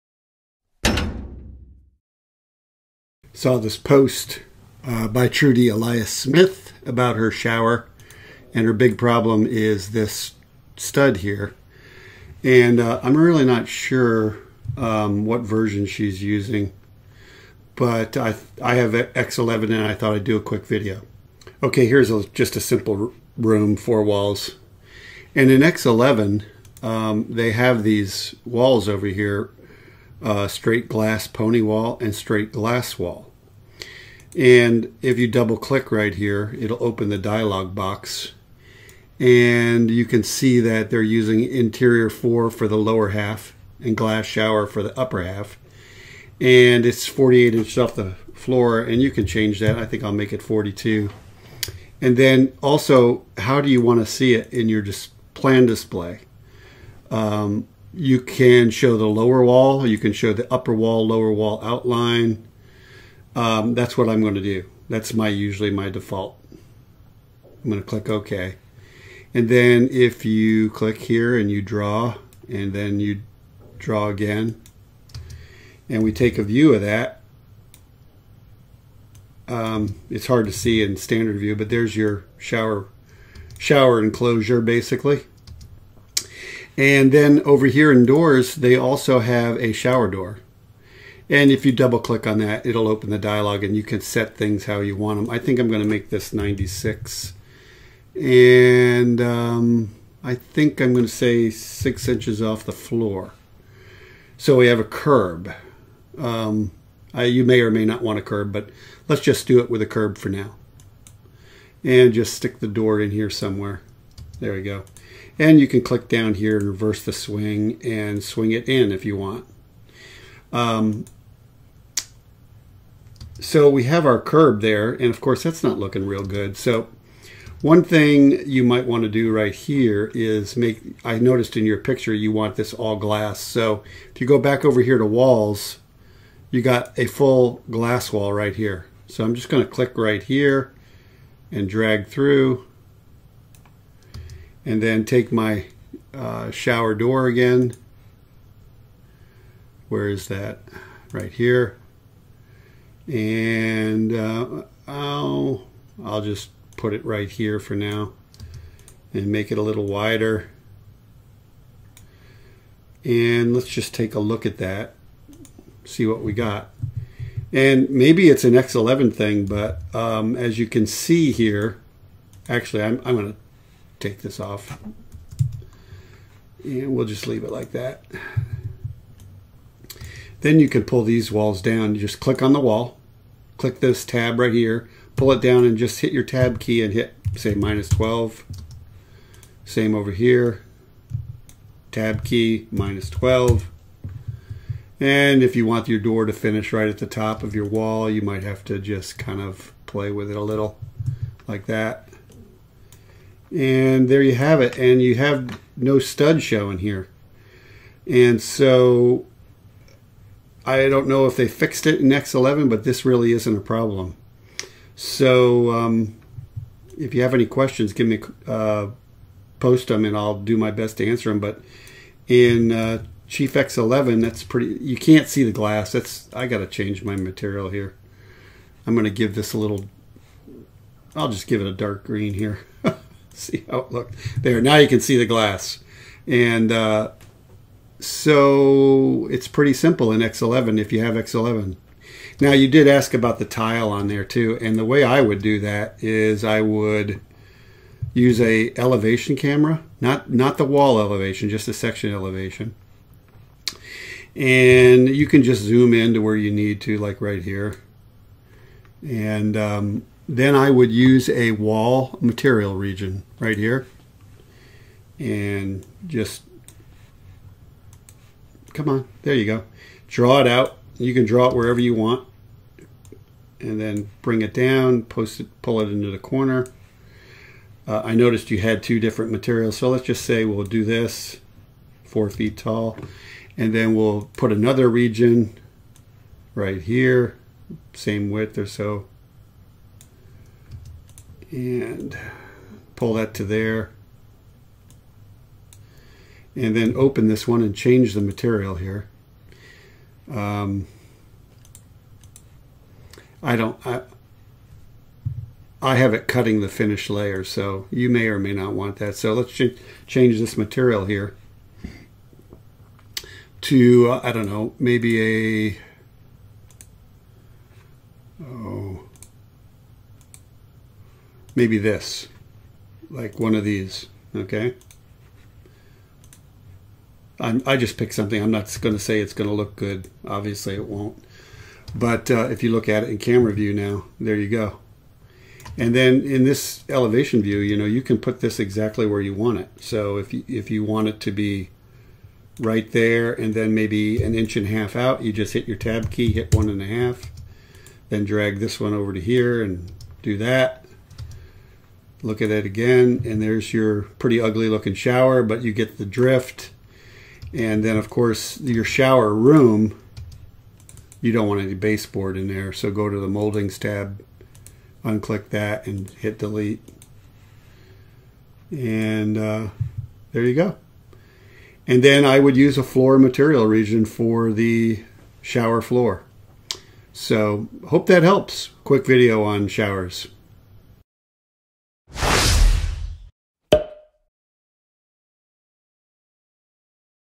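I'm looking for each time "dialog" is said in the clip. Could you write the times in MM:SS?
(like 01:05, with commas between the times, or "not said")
00:37, 01:33.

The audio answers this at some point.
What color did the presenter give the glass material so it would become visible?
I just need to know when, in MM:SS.
03:51.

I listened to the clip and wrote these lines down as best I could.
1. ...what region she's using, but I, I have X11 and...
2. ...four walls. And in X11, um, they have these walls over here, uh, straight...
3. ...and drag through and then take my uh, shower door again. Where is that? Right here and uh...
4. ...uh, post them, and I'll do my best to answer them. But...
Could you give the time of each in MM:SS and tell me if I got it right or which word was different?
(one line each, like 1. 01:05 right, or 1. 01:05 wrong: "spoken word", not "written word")
1. 00:15 wrong: "version", not "region"
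2. 00:23 right
3. 02:21 right
4. 03:38 right.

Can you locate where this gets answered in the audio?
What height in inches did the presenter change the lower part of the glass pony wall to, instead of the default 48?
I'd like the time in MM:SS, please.
00:50.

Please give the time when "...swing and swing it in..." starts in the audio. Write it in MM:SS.
01:57.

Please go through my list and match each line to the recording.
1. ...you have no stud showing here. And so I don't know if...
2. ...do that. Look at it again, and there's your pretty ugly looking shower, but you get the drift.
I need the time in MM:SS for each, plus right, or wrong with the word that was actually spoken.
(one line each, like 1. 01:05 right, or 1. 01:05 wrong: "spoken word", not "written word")
1. 03:25 right
2. 05:50 right.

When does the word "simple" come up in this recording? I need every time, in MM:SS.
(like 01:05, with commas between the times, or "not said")
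00:22, 03:59.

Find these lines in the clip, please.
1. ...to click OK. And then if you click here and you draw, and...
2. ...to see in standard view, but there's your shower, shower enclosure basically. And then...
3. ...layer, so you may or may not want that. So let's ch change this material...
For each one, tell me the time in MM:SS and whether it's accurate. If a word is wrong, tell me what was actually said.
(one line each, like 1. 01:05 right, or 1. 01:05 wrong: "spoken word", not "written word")
1. 01:07 right
2. 01:20 right
3. 05:07 right.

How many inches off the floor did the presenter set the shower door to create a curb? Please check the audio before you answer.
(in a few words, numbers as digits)
6.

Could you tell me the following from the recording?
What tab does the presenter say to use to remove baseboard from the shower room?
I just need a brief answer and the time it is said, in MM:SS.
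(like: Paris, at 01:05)
Moldings tab, at 06:03.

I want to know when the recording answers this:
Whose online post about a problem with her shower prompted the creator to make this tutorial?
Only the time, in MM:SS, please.
00:05.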